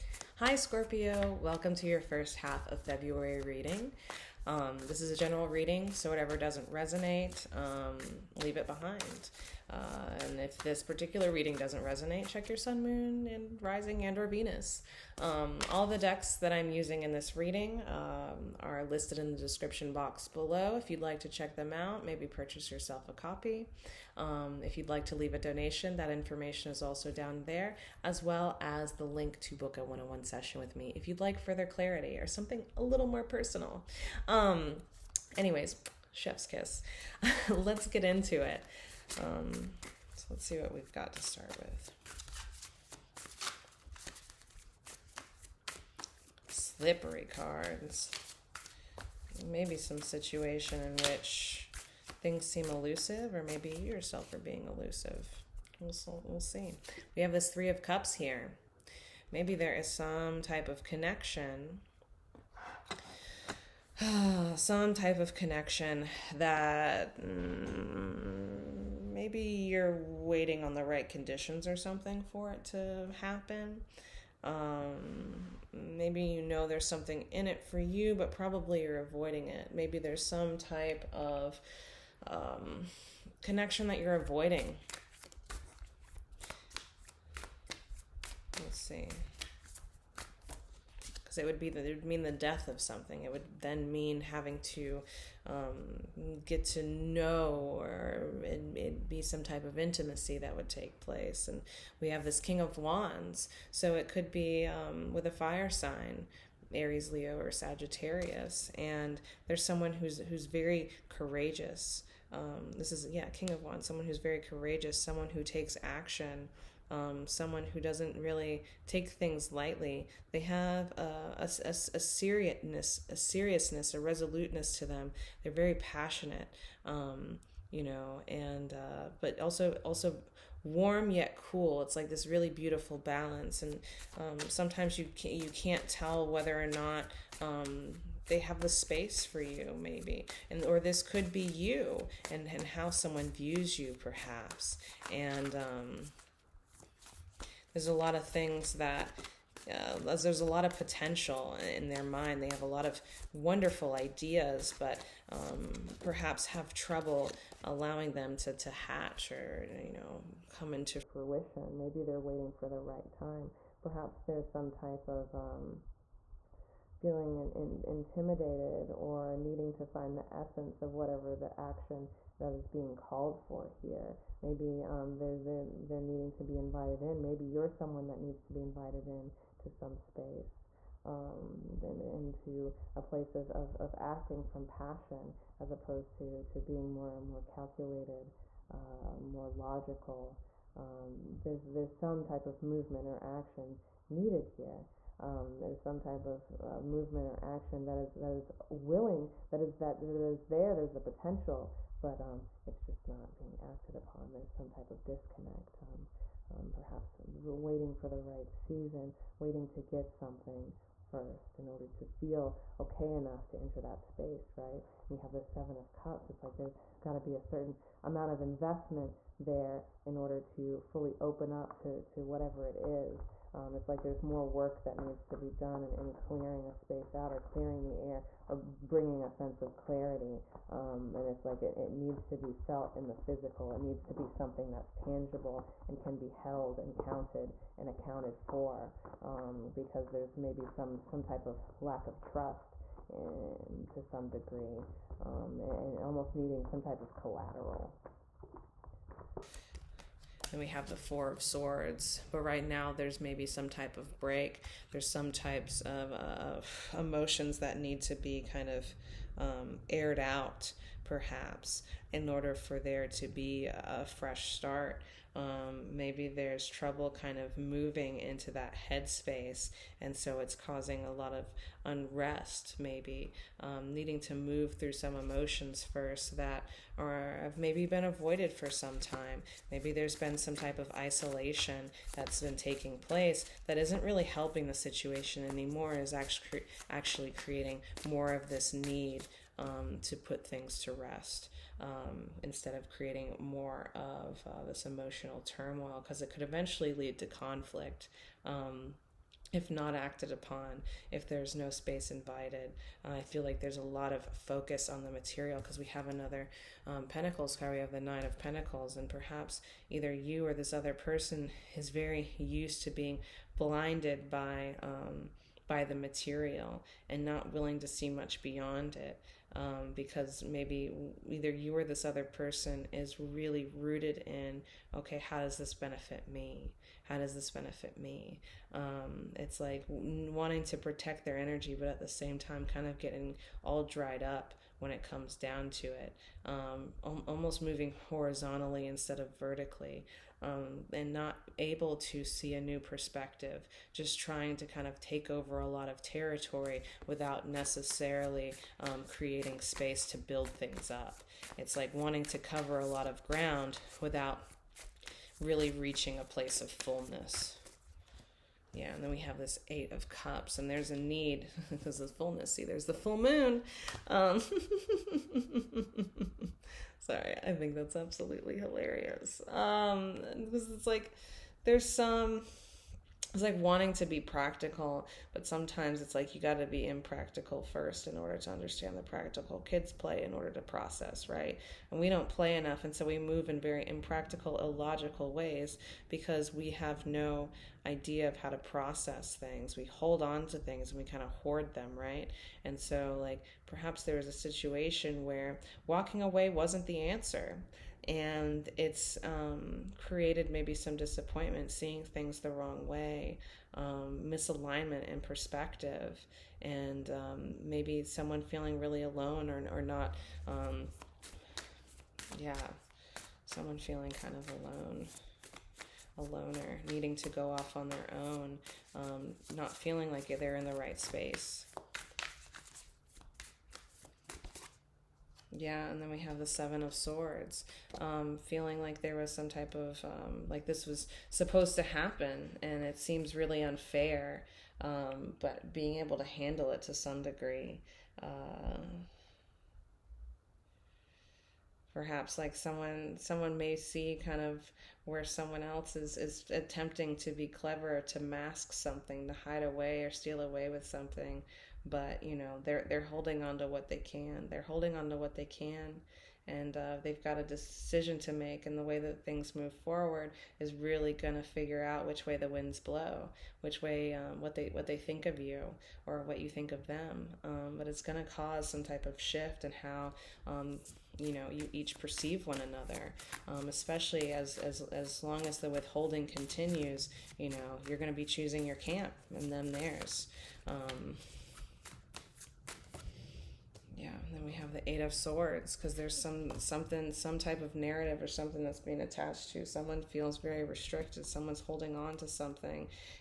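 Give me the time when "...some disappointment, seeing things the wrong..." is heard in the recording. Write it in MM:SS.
06:40.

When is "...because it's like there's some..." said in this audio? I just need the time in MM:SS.
06:10.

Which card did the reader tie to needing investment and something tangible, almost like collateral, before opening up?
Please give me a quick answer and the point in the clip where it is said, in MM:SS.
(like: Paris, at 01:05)
Seven of Cups, at 03:35.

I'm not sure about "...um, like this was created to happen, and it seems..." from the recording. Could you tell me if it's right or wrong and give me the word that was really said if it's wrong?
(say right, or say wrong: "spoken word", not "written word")
wrong: "supposed", not "created".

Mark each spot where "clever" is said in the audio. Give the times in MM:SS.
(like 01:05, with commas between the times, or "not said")
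07:27.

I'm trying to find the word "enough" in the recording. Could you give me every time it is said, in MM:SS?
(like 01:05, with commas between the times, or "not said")
03:33, 06:22.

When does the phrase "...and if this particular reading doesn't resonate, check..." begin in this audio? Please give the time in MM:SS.
00:10.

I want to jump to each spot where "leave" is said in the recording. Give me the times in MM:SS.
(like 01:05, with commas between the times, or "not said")
00:08, 00:25.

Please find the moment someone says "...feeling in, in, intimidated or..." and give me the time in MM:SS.
02:46.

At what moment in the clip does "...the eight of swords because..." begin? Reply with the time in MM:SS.
08:04.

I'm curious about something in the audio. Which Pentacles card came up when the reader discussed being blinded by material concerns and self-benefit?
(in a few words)
Nine of Pentacles.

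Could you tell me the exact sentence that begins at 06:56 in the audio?
A loner needing to go off on their own, um, not feeling like they're in the right space.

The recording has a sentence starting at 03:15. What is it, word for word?
Um, there's some type of uh, movement or action that is that is willing, that is that that is there.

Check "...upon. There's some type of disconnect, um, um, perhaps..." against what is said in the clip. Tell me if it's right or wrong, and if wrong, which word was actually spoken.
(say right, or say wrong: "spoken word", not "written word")
right.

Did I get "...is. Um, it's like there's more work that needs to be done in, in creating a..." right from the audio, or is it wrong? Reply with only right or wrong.
wrong.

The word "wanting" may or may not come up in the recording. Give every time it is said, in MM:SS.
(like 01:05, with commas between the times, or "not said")
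05:29, 05:51, 06:13.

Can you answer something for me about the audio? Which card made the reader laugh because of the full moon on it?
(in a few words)
Eight of Cups.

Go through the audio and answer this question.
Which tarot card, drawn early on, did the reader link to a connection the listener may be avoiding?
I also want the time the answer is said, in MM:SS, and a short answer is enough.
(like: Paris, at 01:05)
Three of Cups, at 00:57.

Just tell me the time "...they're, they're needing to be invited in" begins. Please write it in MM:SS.
02:55.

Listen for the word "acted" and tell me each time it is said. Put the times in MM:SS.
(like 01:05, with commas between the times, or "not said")
03:23, 04:59.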